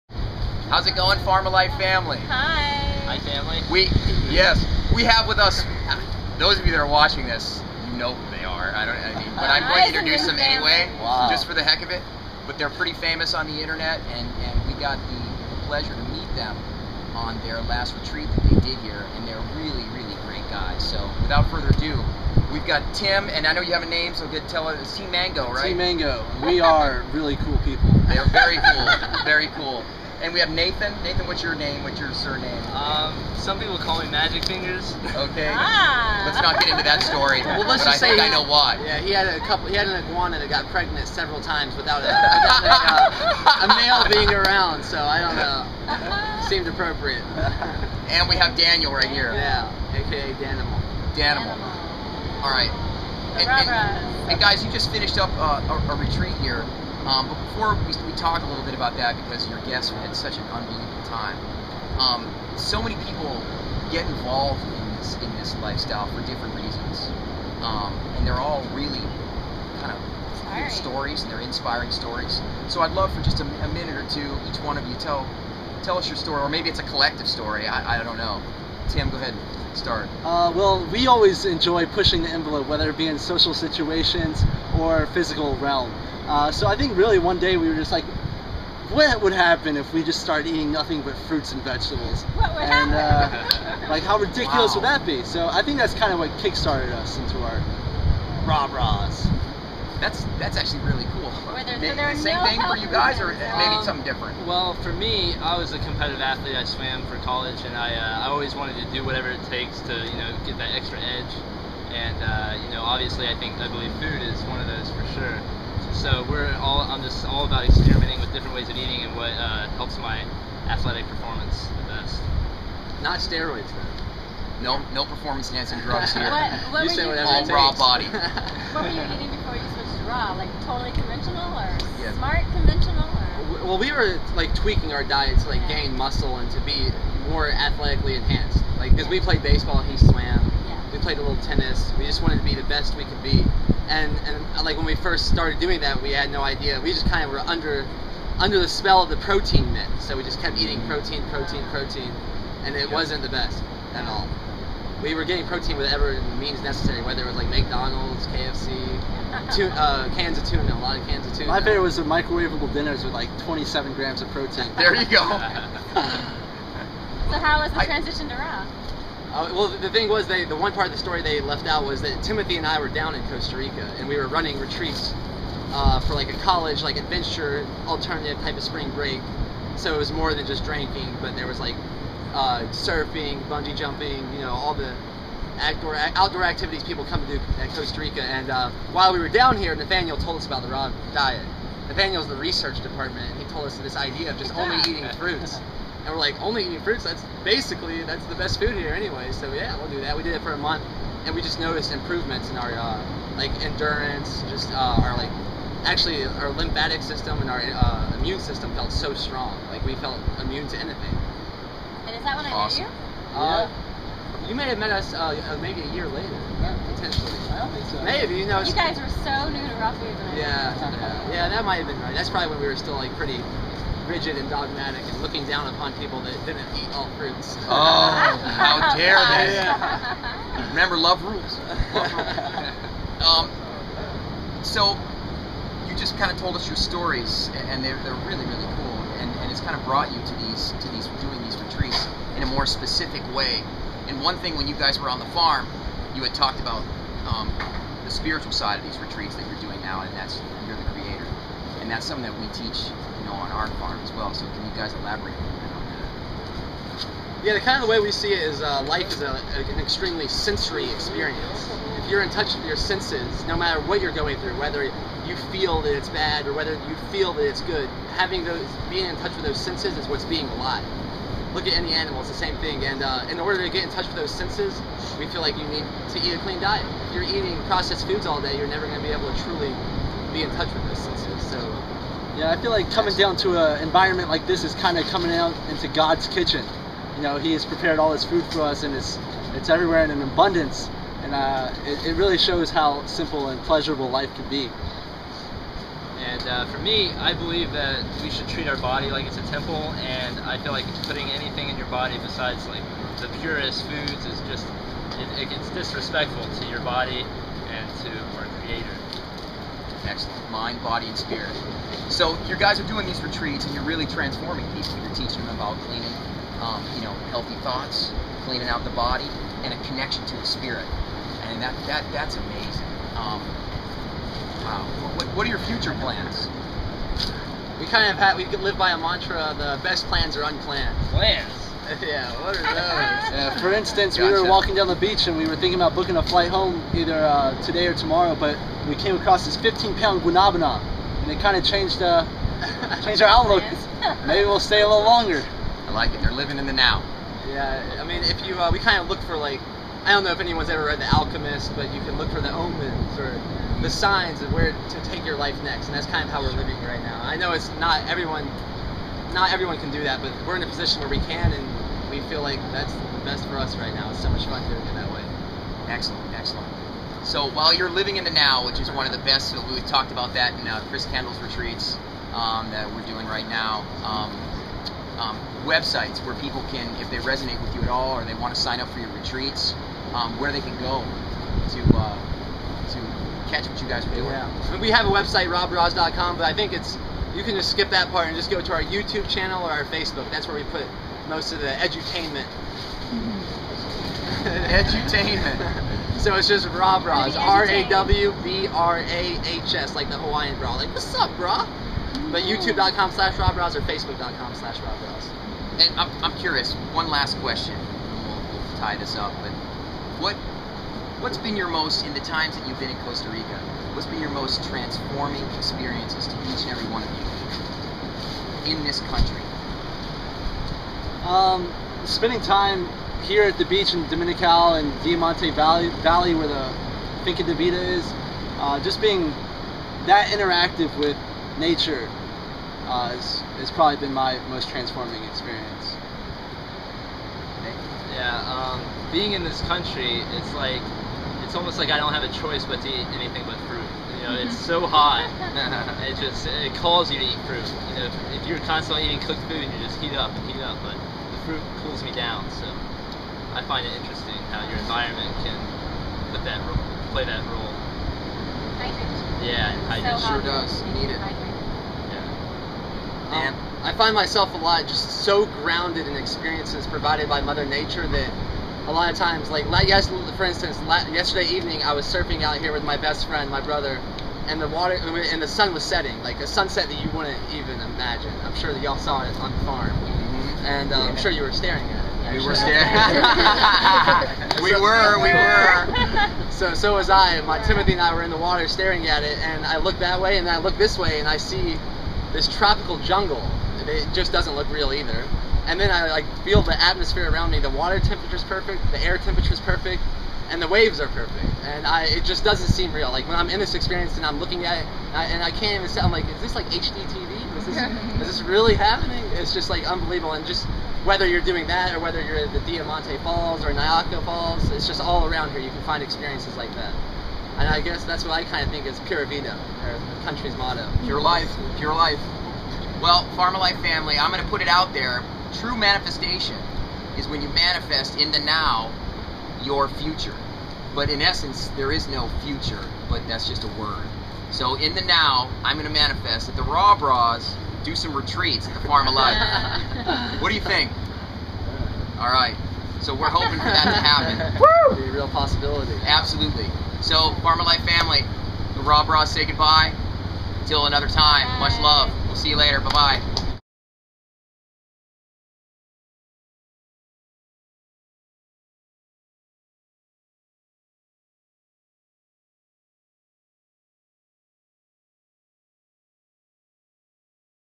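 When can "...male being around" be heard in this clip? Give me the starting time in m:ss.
0:43.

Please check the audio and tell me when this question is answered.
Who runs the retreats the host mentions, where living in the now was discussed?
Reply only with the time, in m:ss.
6:10.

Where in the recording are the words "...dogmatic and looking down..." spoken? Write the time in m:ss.
3:44.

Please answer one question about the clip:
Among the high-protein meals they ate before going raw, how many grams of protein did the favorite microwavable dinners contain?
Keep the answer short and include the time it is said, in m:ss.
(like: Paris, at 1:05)
27, at 2:43.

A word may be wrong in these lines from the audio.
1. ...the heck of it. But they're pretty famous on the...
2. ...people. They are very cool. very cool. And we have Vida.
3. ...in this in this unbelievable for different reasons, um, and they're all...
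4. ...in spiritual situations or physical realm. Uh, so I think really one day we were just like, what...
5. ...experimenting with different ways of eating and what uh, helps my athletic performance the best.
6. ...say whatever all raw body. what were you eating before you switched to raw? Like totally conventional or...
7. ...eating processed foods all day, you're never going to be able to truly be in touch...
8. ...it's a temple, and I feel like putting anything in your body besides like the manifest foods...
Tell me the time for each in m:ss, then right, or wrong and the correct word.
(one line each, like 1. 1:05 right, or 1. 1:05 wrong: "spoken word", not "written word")
1. 0:11 right
2. 0:27 wrong: "Nathan", not "Vida"
3. 1:04 wrong: "lifestyle", not "unbelievable"
4. 1:23 wrong: "social", not "spiritual"
5. 1:57 right
6. 2:06 right
7. 4:37 right
8. 4:59 wrong: "purest", not "manifest".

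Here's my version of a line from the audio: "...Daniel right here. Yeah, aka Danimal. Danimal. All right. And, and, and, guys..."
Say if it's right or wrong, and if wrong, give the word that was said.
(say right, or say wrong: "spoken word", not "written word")
right.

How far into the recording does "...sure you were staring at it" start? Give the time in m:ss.
8:01.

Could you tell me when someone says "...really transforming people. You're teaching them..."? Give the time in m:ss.
5:13.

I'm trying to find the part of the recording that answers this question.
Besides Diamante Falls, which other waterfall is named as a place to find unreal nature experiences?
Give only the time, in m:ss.
8:33.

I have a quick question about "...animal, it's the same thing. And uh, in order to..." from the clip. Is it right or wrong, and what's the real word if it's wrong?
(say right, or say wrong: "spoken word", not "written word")
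right.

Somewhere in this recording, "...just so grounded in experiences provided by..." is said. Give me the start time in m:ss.
7:44.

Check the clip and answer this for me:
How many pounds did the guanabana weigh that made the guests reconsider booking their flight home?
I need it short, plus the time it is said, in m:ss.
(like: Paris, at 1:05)
15, at 5:39.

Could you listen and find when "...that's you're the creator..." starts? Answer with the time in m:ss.
4:10.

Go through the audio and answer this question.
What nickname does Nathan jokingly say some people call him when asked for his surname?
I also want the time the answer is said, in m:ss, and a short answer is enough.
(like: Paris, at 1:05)
Magic Fingers, at 0:34.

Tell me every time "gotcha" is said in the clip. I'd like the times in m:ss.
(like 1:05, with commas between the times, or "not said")
5:34.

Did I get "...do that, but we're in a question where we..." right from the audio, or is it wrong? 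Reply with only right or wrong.
wrong.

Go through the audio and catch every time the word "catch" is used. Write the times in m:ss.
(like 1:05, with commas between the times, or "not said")
6:23.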